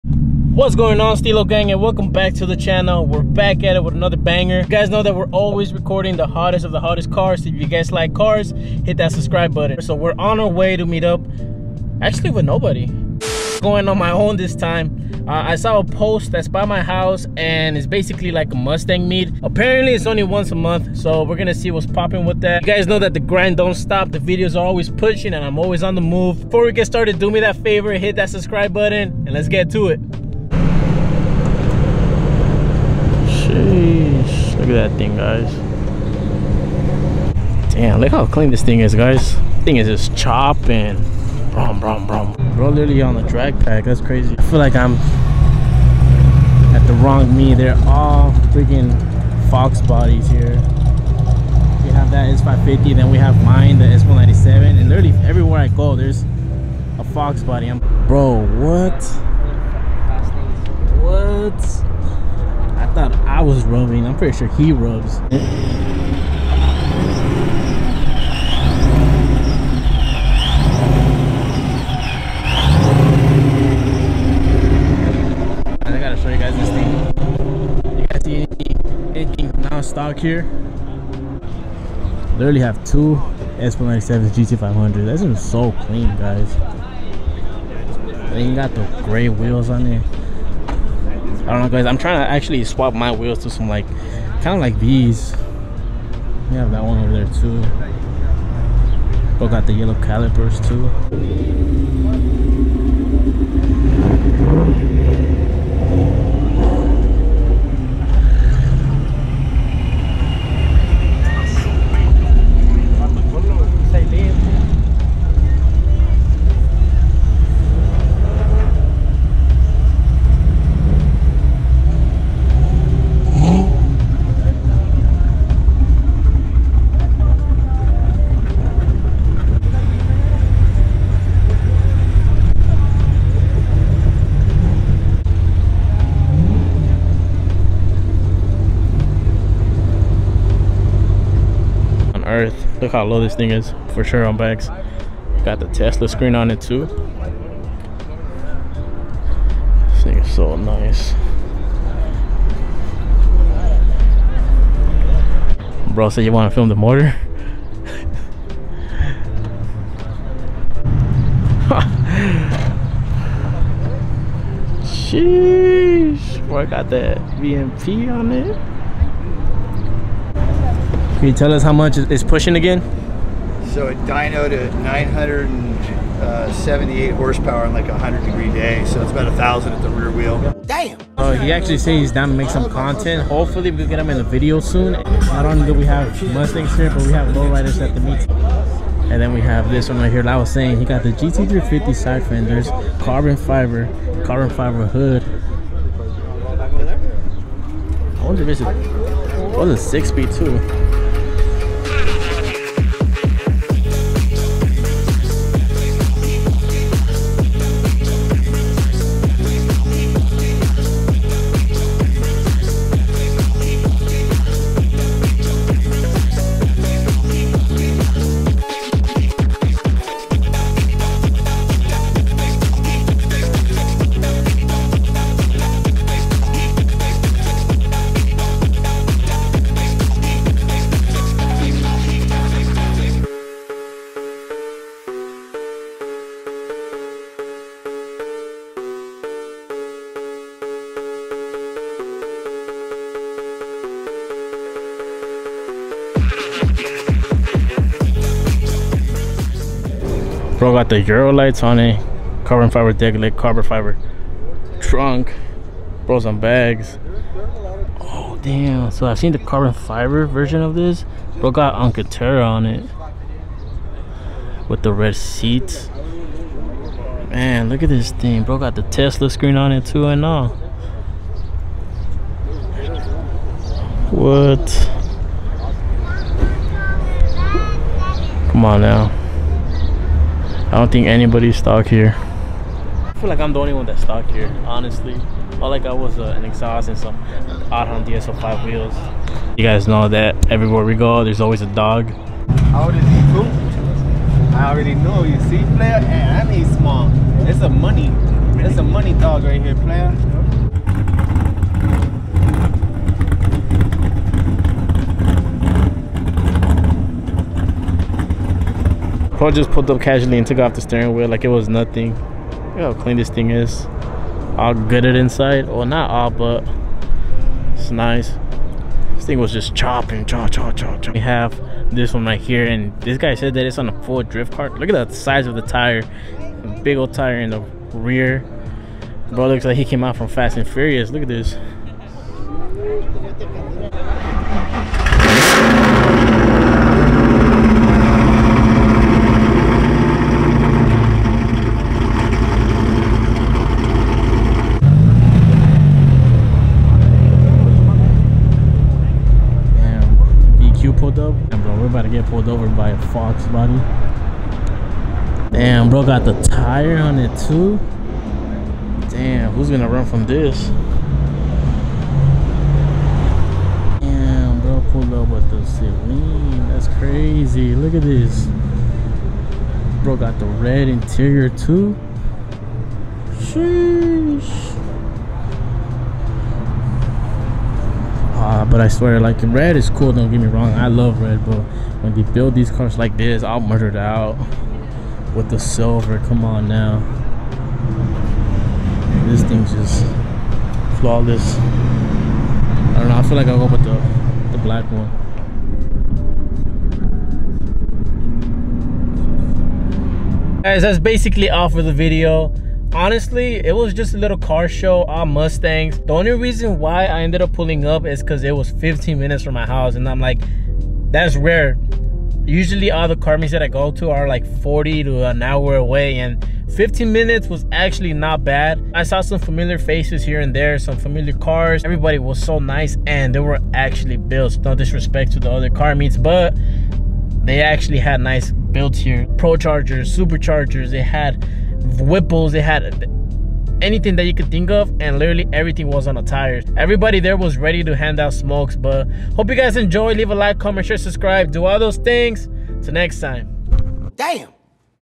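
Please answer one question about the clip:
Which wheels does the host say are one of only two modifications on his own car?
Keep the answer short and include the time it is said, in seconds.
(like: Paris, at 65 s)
Aram DS05, at 287 s.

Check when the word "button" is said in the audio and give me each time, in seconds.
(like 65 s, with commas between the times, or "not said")
9 s, 28 s.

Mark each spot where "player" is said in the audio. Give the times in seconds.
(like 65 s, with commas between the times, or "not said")
295 s, 299 s.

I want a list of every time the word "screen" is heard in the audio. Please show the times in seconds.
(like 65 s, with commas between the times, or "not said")
146 s, 269 s.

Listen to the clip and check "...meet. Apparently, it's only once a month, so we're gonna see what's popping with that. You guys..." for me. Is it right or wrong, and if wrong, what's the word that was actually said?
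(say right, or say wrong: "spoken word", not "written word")
right.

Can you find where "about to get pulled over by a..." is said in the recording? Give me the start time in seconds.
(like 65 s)
351 s.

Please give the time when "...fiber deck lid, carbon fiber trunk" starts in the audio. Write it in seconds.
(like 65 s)
252 s.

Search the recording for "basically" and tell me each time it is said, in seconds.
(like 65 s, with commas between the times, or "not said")
17 s, 400 s.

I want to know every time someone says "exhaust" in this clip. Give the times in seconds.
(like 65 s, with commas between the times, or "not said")
286 s.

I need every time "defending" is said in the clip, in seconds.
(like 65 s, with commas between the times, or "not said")
not said.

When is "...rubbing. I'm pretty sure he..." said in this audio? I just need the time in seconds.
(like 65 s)
63 s.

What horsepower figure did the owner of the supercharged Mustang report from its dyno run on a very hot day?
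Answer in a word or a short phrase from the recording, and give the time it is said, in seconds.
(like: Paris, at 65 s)
978, at 174 s.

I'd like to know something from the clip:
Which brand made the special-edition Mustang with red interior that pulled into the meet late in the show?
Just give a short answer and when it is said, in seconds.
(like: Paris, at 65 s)
Saleen, at 365 s.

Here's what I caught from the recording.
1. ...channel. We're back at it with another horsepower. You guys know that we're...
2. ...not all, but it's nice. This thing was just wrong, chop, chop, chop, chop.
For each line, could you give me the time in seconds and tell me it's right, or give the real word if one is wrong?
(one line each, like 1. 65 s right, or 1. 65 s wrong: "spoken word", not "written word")
1. 2 s wrong: "banger", not "horsepower"
2. 315 s wrong: "chopping", not "wrong".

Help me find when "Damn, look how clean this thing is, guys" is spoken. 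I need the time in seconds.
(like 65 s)
37 s.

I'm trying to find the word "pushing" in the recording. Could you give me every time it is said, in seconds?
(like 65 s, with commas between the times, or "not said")
24 s, 172 s.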